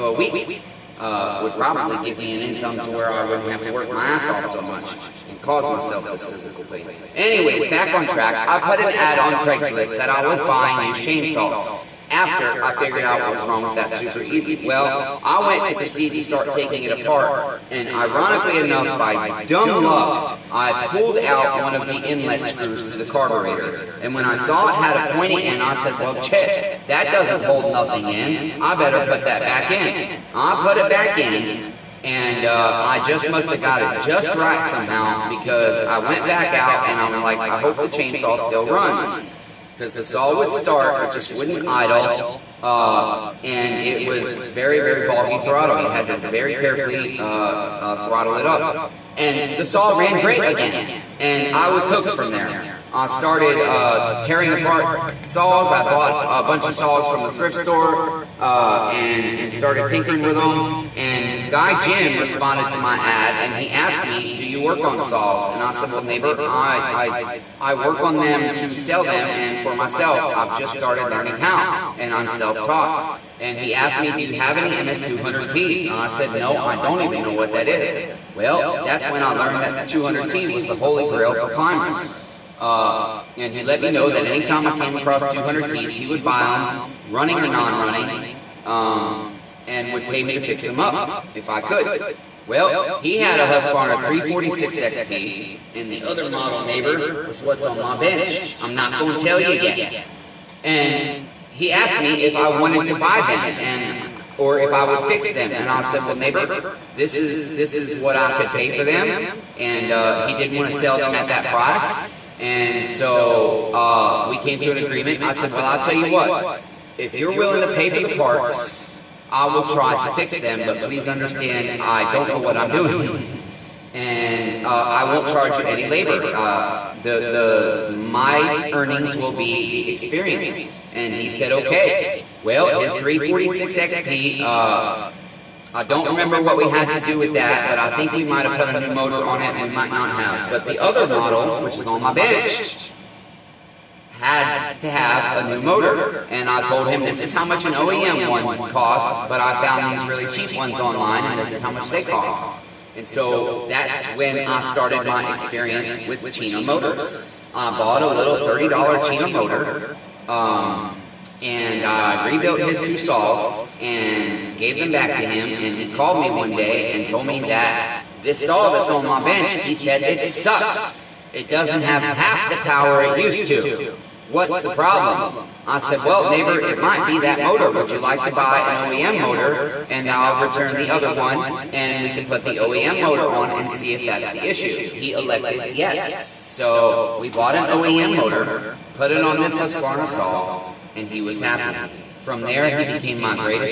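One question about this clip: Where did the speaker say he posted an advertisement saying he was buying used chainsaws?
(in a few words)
Craigslist.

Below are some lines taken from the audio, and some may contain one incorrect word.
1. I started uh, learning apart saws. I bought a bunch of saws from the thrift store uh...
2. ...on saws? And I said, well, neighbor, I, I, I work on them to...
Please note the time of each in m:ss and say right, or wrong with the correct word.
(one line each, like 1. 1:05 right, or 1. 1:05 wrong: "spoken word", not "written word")
1. 0:52 wrong: "tearing", not "learning"
2. 1:04 right.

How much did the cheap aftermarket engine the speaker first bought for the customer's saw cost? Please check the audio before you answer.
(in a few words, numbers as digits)
$30.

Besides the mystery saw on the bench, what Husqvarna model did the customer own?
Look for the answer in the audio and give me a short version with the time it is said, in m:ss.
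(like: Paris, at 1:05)
Husqvarna 346 XP, at 1:33.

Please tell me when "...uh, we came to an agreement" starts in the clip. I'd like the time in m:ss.
1:53.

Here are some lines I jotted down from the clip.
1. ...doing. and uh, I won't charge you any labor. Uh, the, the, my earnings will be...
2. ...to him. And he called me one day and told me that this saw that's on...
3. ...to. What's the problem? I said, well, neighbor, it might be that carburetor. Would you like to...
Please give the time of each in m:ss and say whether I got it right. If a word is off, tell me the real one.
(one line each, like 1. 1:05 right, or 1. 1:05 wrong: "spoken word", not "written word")
1. 2:02 right
2. 2:45 right
3. 2:53 wrong: "motor", not "carburetor".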